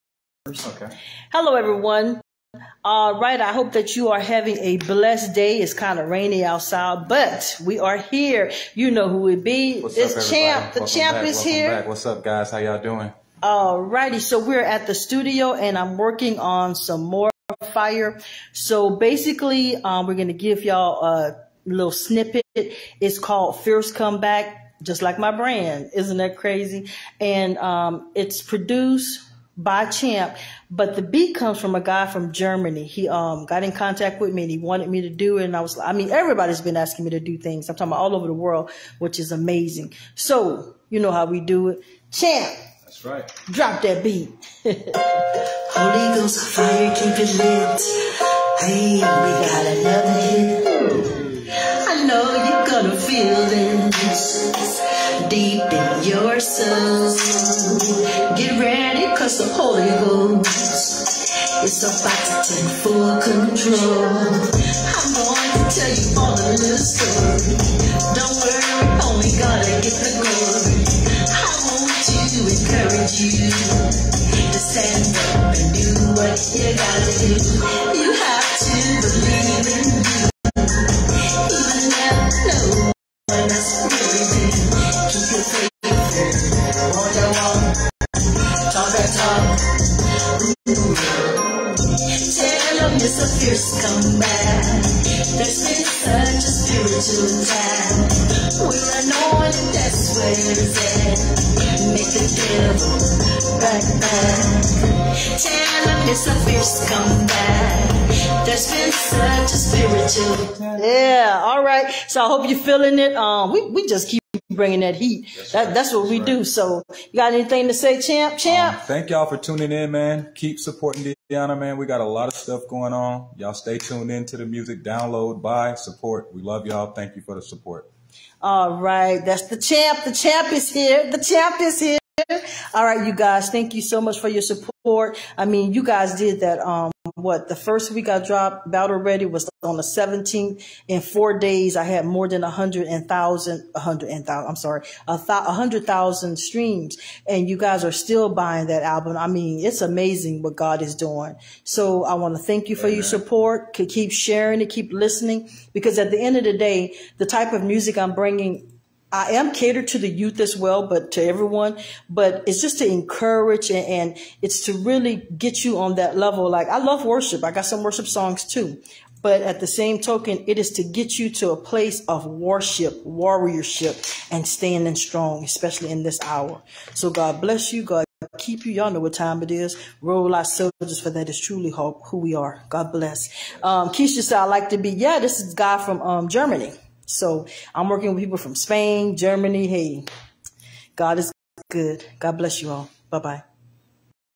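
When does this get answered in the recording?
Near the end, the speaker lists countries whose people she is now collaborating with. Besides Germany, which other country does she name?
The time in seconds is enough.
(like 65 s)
188 s.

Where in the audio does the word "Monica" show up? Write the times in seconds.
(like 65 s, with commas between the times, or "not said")
not said.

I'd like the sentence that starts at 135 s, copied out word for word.
I mean, you guys did that.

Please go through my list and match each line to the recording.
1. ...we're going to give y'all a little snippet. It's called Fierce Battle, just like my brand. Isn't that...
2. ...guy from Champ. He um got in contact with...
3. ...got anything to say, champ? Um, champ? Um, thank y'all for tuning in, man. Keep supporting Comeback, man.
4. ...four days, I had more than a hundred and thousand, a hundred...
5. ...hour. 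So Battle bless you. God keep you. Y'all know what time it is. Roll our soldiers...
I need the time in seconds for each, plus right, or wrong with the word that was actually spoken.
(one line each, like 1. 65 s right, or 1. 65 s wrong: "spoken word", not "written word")
1. 20 s wrong: "Comeback", not "Battle"
2. 31 s wrong: "Germany", not "Champ"
3. 117 s wrong: "Deanna", not "Comeback"
4. 141 s right
5. 176 s wrong: "God", not "Battle".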